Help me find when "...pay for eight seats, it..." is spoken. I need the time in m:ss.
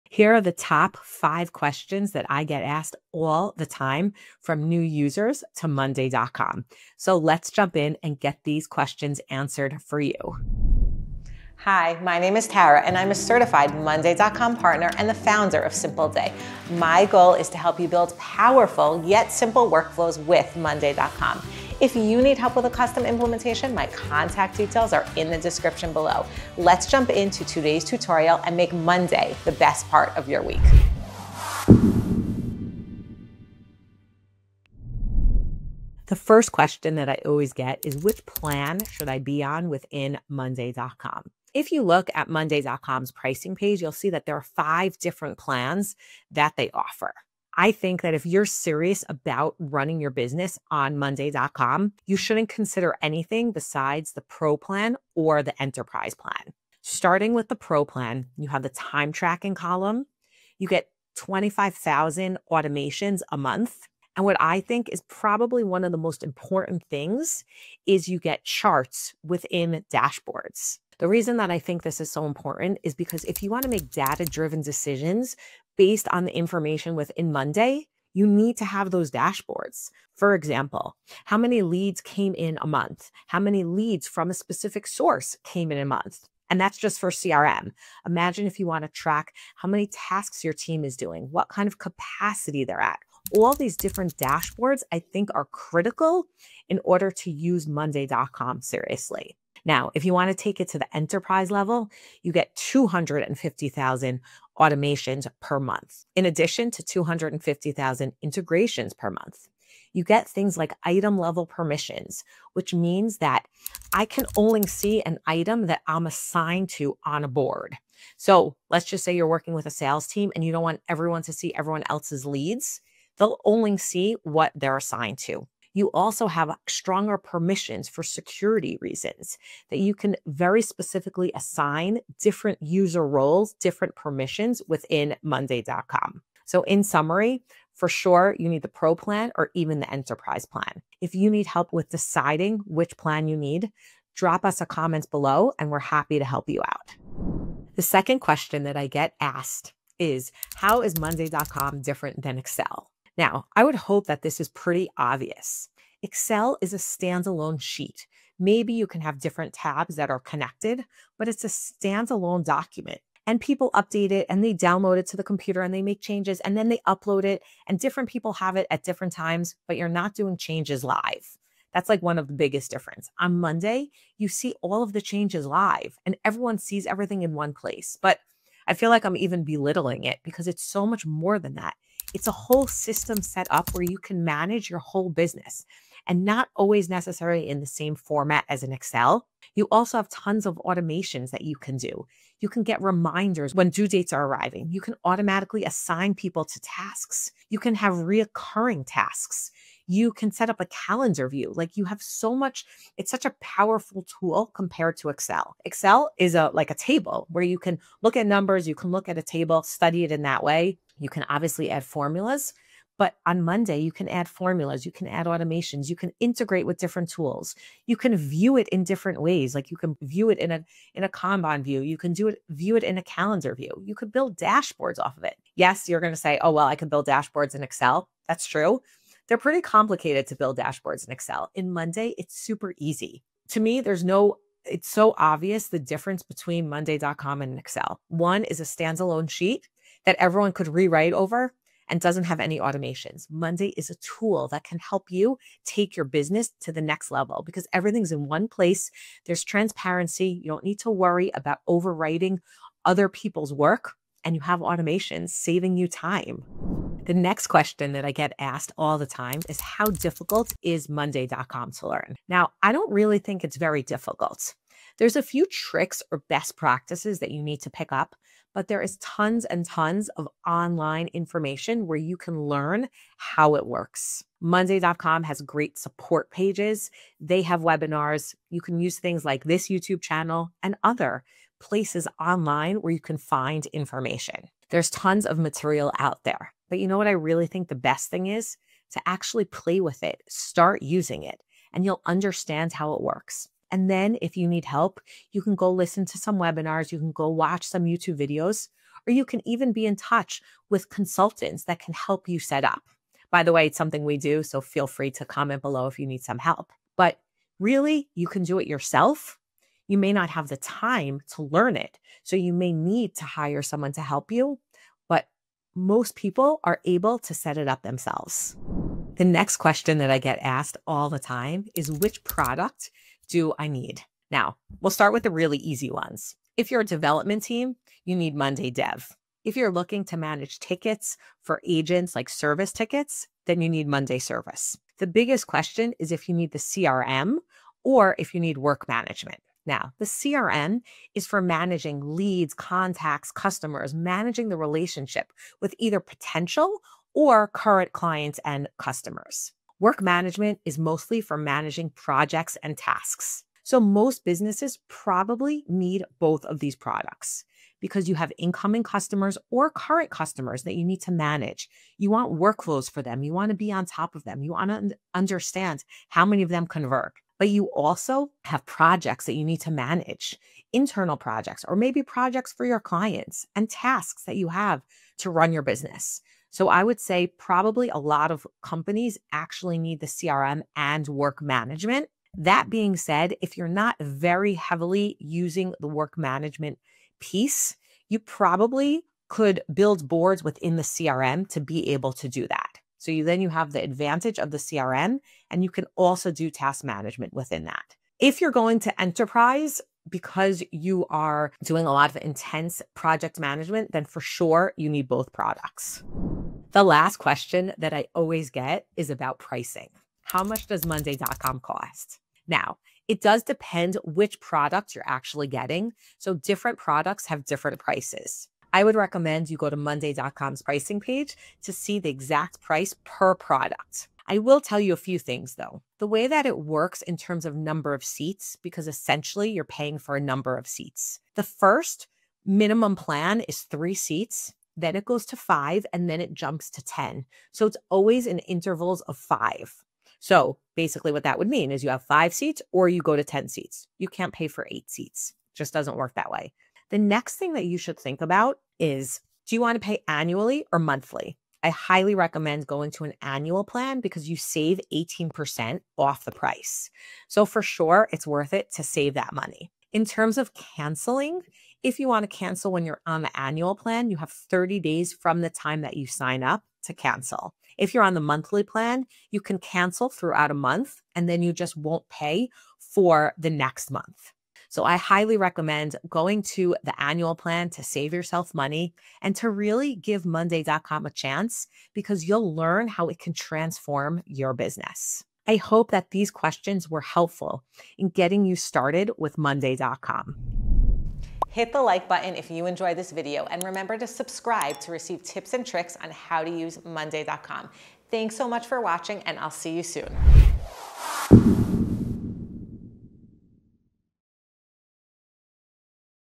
7:24.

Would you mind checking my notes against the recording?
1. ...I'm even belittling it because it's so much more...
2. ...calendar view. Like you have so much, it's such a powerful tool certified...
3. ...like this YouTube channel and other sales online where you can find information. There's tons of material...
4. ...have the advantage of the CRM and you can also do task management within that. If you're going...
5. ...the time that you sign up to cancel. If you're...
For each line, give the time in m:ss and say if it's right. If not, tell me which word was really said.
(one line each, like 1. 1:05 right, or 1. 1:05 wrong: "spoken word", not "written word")
1. 2:59 right
2. 3:20 wrong: "compared", not "certified"
3. 4:39 wrong: "places", not "sales"
4. 6:33 right
5. 7:45 right.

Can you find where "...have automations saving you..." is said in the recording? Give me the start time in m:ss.
4:14.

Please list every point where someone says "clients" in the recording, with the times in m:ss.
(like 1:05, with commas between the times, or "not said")
5:47, 6:12.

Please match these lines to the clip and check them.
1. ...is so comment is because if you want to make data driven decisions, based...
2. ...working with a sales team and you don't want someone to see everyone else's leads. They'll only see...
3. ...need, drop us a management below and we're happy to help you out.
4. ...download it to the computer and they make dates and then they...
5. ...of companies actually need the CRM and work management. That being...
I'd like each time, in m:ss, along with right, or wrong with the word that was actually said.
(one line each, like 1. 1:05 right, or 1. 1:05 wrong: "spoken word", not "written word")
1. 1:11 wrong: "important", not "comment"
2. 1:59 wrong: "everyone", not "someone"
3. 2:23 wrong: "comment", not "management"
4. 2:44 wrong: "changes", not "dates"
5. 6:18 right.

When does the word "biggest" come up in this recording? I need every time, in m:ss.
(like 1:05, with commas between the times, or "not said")
2:52, 5:35.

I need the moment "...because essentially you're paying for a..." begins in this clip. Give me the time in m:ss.
7:08.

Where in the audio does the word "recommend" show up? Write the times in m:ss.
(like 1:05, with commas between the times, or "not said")
6:58, 7:32, 7:55.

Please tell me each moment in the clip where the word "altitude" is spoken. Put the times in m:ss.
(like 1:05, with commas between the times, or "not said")
not said.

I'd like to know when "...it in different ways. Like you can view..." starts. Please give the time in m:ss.
3:38.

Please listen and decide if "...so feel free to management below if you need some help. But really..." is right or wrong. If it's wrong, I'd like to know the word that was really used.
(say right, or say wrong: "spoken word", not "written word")
wrong: "comment", not "management".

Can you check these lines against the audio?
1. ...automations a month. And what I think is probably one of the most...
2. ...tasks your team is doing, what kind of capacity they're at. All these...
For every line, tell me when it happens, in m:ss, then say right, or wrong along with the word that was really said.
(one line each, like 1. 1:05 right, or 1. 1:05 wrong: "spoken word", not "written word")
1. 1:02 right
2. 1:29 right.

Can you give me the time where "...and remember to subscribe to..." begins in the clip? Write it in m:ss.
8:13.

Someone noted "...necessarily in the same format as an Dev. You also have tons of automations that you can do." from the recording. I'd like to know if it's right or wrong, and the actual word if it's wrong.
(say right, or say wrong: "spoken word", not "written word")
wrong: "Excel", not "Dev".